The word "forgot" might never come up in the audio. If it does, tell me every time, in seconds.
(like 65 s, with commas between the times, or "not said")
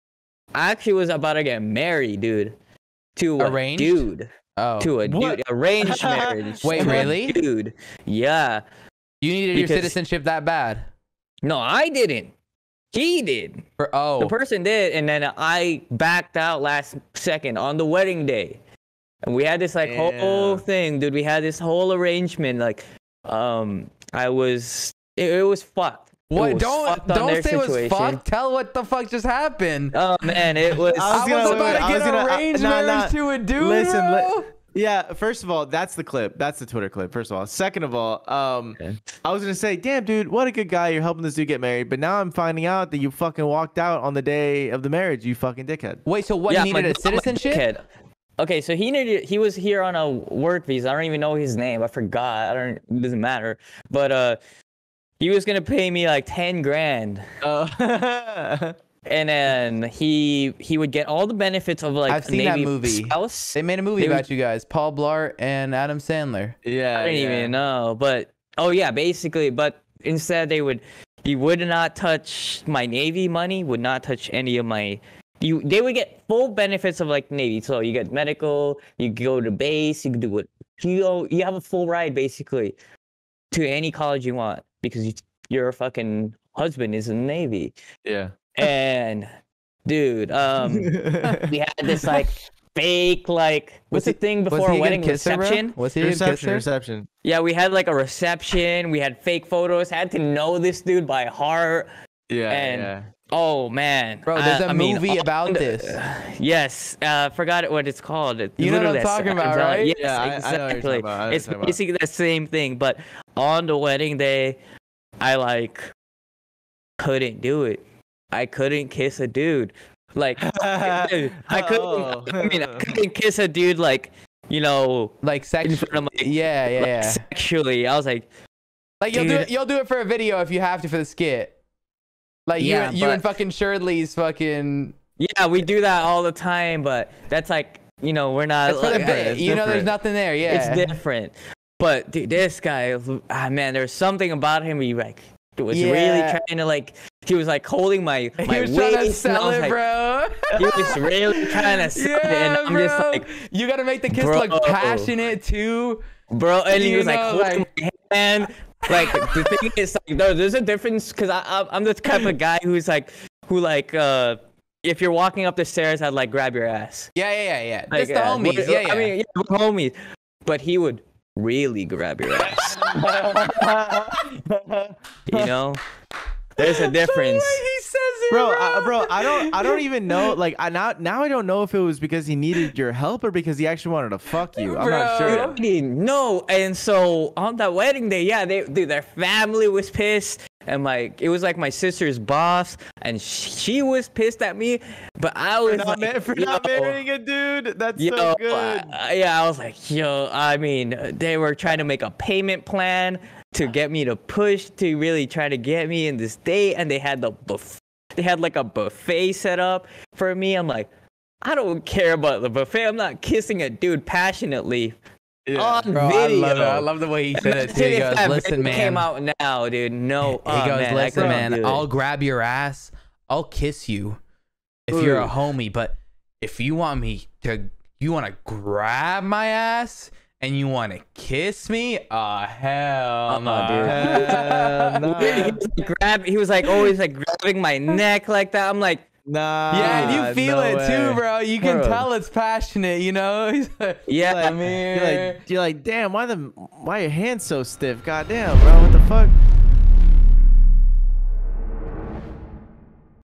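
51 s, 107 s.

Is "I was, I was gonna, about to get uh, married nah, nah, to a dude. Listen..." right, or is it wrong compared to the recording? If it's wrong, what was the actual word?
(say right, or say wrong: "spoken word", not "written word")
wrong: "arranged", not "married".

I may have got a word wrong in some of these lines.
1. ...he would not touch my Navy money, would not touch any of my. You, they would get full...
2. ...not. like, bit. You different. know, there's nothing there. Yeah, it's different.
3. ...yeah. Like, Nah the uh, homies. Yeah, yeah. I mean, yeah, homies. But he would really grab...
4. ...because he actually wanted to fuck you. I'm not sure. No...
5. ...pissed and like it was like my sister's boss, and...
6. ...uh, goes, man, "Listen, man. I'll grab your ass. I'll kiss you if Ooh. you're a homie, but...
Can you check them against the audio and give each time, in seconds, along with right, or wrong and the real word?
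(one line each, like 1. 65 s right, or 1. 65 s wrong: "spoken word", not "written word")
1. 71 s right
2. 138 s right
3. 167 s wrong: "Just", not "Nah"
4. 183 s right
5. 189 s right
6. 220 s right.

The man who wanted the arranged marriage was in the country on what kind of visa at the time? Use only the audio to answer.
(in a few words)
Work visa.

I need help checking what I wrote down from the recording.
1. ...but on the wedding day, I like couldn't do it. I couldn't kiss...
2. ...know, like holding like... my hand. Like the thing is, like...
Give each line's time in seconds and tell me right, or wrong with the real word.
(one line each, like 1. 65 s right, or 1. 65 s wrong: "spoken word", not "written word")
1. 112 s right
2. 157 s right.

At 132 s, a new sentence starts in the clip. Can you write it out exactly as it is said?
Like yeah, you, you but, and fucking Cherdleys fucking.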